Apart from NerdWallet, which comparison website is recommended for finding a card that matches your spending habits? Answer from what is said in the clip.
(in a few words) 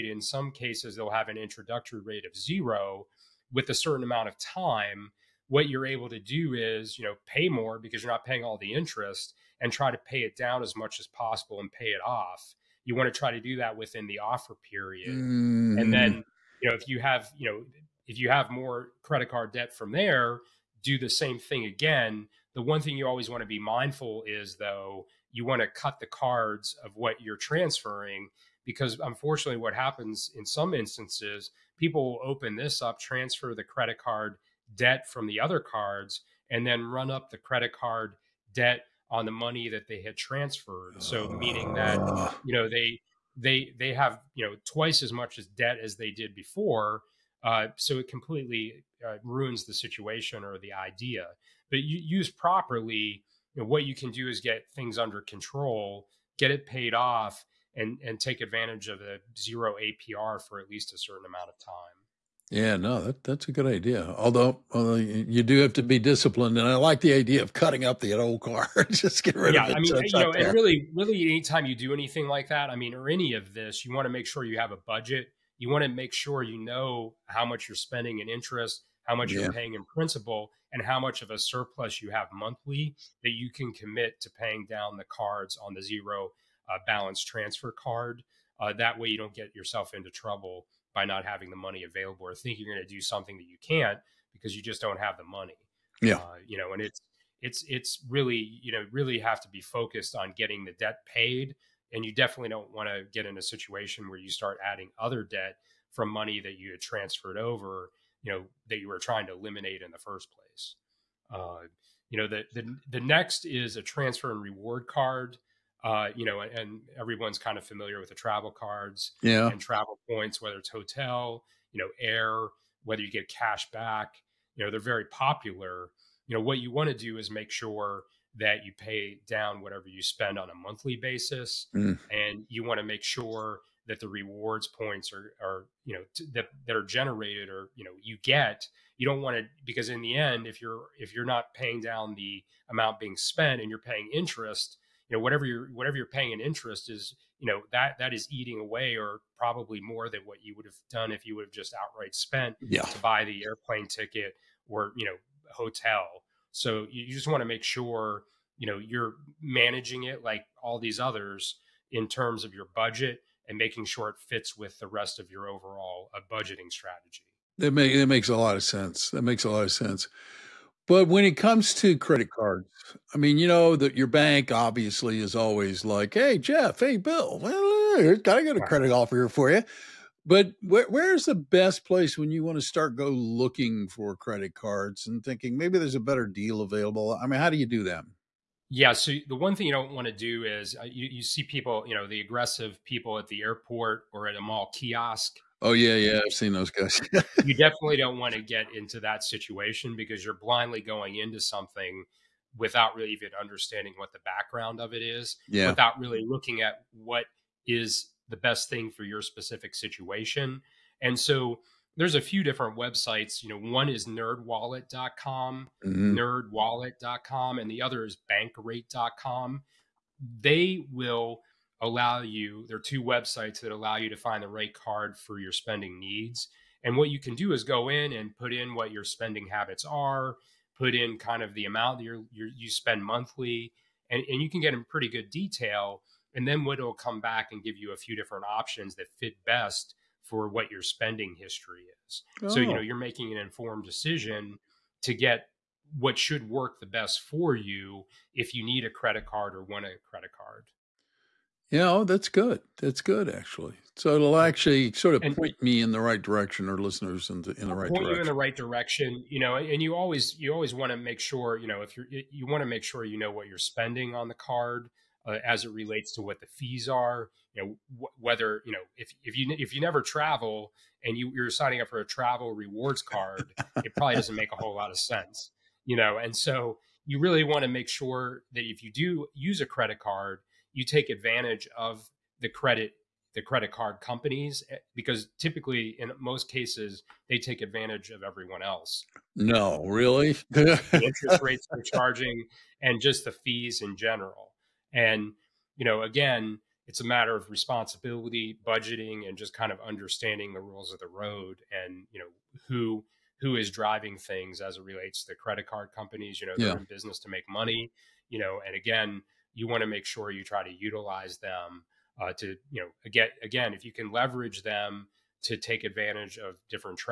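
bankrate.com.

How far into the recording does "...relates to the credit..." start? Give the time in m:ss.
5:04.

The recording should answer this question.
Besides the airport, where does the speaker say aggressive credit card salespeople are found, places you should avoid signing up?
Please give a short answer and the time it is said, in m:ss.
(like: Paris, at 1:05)
A mall kiosk, at 3:14.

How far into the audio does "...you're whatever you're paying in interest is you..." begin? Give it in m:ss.
2:25.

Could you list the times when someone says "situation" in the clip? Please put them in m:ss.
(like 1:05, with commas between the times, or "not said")
0:49, 1:43, 3:19, 3:29.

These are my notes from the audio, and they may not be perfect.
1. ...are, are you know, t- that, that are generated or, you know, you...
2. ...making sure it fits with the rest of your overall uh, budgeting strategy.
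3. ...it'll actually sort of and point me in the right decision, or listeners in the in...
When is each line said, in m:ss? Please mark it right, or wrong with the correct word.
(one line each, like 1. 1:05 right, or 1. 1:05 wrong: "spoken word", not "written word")
1. 2:15 right
2. 2:43 right
3. 4:14 wrong: "direction", not "decision".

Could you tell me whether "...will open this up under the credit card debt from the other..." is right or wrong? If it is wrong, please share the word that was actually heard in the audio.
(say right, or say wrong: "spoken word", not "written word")
wrong: "transfer", not "under".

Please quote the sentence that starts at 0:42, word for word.
you know they they they have you know twice as much as debt as they did before.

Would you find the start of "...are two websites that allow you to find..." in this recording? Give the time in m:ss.
3:42.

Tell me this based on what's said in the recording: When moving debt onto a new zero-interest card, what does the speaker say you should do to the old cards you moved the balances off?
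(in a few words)
Cut the cards.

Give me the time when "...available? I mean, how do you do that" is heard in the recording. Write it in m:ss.
3:06.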